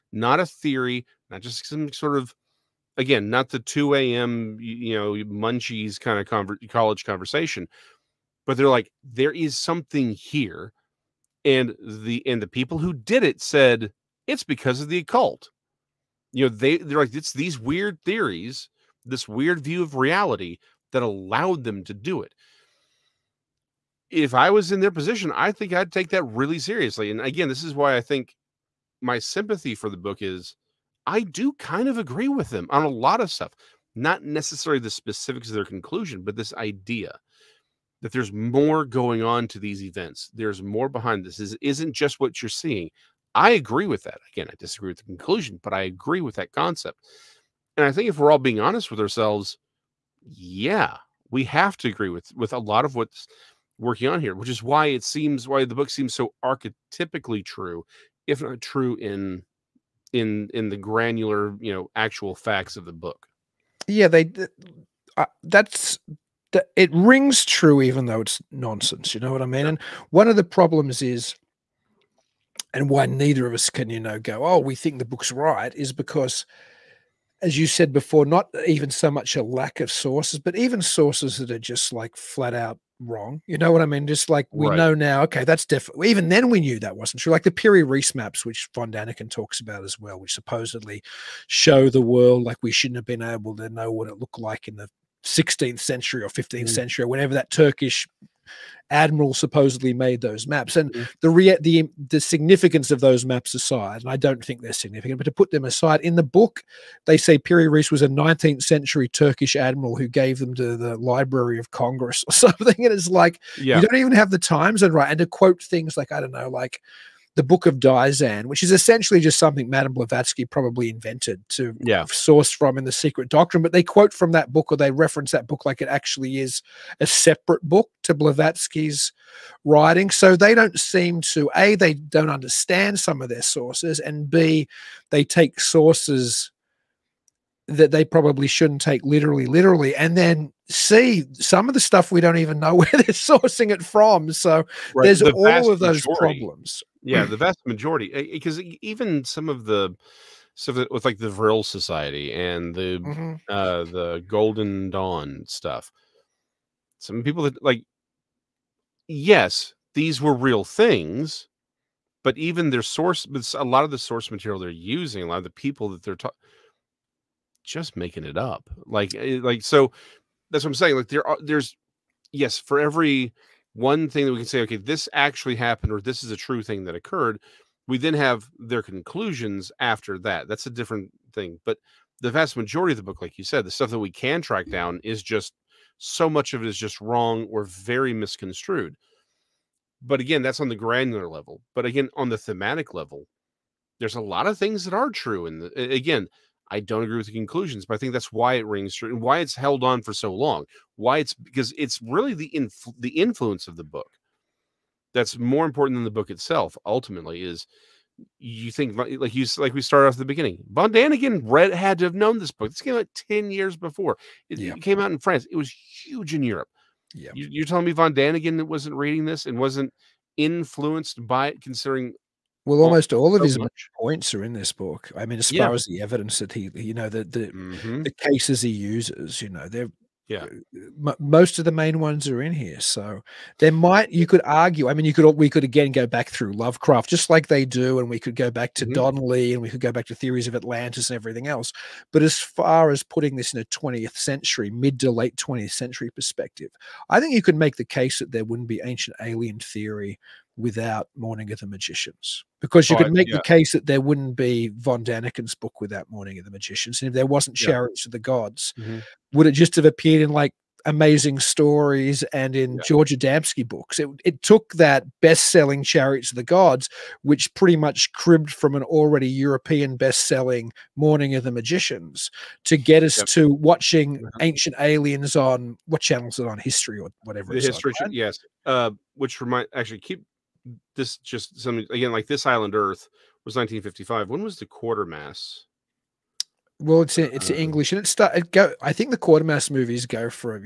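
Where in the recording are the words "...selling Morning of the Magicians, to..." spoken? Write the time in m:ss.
4:30.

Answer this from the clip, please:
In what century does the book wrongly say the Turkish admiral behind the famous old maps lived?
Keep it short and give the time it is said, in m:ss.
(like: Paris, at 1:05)
19th century, at 1:48.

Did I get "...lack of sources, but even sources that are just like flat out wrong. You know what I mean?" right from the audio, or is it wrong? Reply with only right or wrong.
right.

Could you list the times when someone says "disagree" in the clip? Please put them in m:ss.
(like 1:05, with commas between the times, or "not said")
0:44.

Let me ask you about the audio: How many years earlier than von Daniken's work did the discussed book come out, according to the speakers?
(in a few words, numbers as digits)
10 years.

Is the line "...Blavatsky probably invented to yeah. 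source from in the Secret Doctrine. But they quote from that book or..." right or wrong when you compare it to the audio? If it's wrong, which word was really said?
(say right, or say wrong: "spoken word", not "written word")
right.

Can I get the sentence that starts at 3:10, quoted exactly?
But again, that's on the granular level.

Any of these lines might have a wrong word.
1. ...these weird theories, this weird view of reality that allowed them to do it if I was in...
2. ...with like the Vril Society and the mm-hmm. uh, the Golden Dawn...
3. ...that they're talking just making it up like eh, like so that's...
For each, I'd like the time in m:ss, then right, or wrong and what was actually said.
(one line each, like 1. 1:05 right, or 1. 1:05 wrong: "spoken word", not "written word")
1. 0:17 right
2. 2:30 right
3. 2:45 right.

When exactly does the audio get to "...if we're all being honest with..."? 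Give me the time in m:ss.
0:48.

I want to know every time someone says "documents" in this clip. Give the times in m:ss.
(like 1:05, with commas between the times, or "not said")
not said.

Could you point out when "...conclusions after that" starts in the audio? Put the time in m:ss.
2:58.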